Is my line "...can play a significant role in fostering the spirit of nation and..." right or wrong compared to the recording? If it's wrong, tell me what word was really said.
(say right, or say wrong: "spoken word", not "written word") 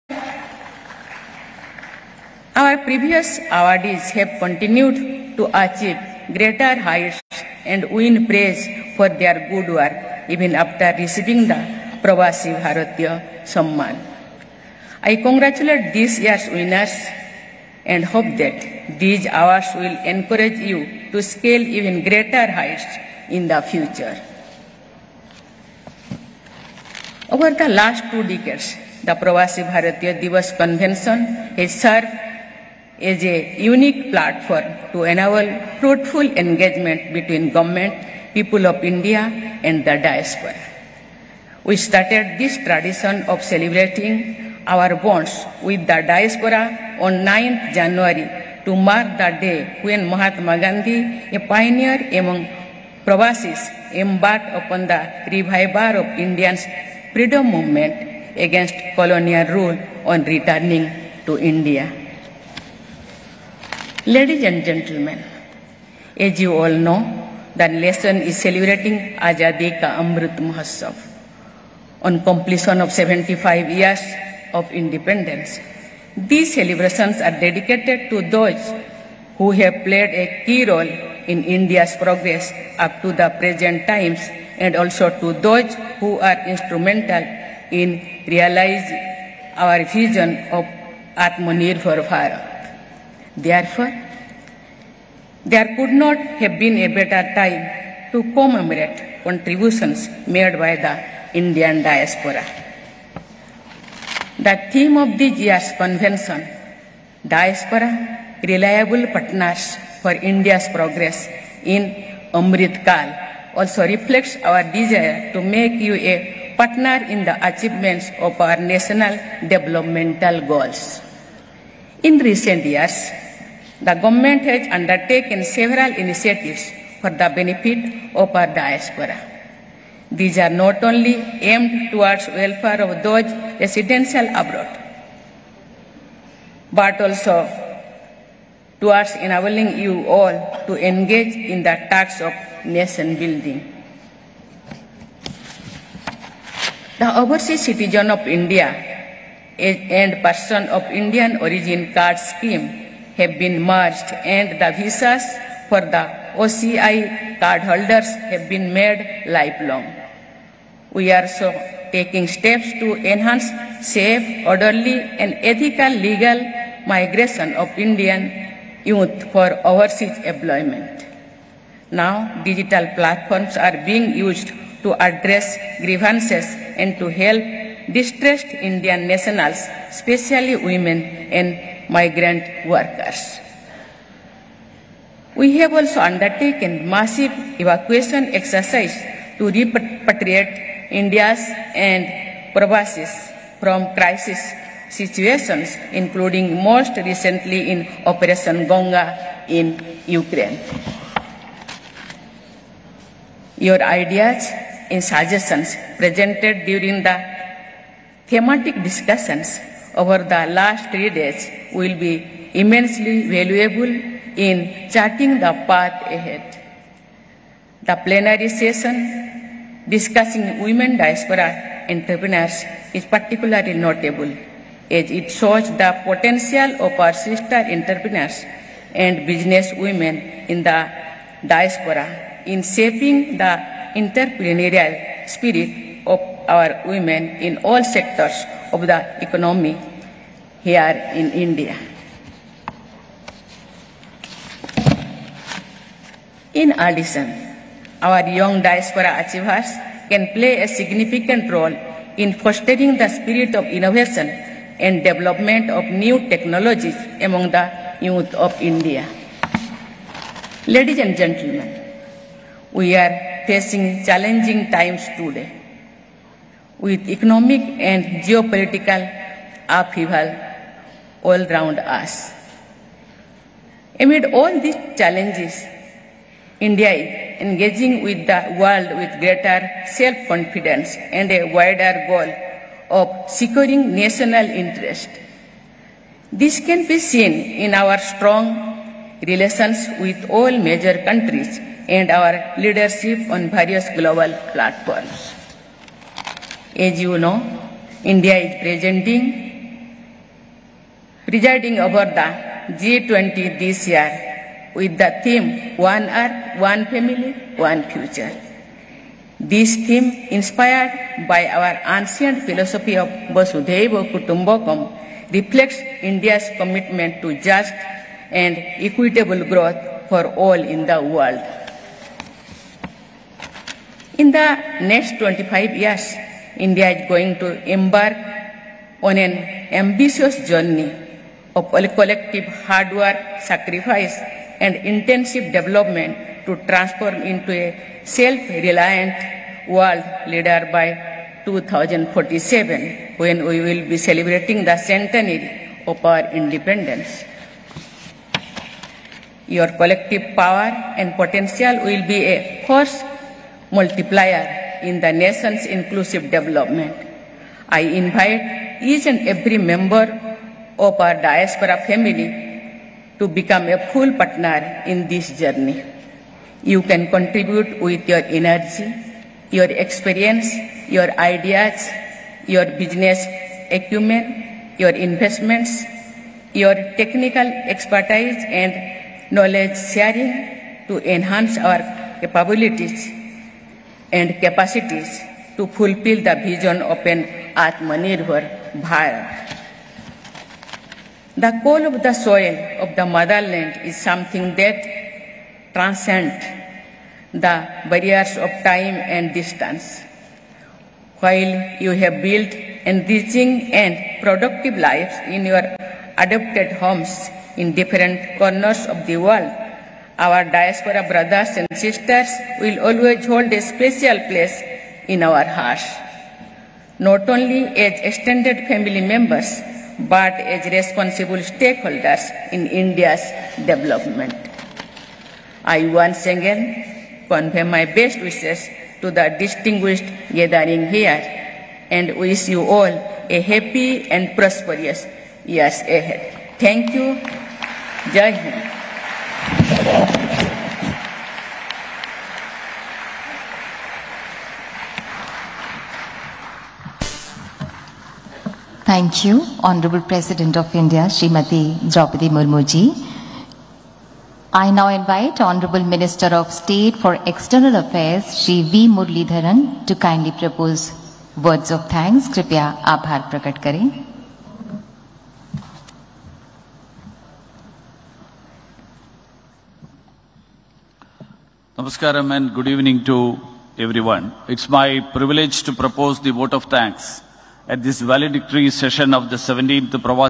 wrong: "innovation", not "nation".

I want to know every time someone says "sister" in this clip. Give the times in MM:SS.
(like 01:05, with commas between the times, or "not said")
03:47, 06:51.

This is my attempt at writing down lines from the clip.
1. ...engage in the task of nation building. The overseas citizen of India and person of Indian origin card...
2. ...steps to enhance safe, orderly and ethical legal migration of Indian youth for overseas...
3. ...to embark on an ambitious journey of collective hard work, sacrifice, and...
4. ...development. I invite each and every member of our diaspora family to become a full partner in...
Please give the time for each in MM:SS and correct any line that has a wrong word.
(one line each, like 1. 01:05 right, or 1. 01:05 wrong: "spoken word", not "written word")
1. 02:20 right
2. 02:42 right
3. 05:27 right
4. 05:56 right.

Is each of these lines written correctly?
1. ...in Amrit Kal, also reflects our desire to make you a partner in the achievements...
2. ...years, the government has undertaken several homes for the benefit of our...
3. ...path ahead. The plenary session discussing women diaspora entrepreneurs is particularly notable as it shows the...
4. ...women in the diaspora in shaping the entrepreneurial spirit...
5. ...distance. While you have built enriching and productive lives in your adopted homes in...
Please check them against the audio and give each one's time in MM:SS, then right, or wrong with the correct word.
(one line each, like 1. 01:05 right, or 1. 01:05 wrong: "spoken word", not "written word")
1. 01:51 right
2. 02:02 wrong: "initiatives", not "homes"
3. 03:35 right
4. 03:49 right
5. 06:39 right.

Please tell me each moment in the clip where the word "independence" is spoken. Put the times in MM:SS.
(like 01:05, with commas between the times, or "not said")
01:14, 05:46.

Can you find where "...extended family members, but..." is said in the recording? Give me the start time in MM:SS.
06:58.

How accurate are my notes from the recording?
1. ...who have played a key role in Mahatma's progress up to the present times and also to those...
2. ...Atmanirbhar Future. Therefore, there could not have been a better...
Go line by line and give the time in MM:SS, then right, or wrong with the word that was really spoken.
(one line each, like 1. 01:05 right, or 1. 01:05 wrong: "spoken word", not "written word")
1. 01:19 wrong: "India", not "Mahatma"
2. 01:31 wrong: "Bharat", not "Future".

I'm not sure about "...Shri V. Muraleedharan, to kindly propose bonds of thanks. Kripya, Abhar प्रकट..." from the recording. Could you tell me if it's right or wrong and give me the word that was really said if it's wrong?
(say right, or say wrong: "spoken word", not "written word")
wrong: "words", not "bonds".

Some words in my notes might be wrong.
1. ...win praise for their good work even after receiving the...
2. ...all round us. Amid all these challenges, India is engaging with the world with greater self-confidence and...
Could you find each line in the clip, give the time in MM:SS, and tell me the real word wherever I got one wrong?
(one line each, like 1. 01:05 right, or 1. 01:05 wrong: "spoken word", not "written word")
1. 00:07 right
2. 04:31 right.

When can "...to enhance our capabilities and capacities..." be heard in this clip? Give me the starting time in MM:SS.
06:20.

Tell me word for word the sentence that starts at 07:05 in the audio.
I once again convey my best wishes to the distinguished gathering here and wish you all a happy and prosperous years ahead.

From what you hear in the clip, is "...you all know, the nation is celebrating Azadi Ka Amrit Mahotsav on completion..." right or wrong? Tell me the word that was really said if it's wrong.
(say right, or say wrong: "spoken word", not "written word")
right.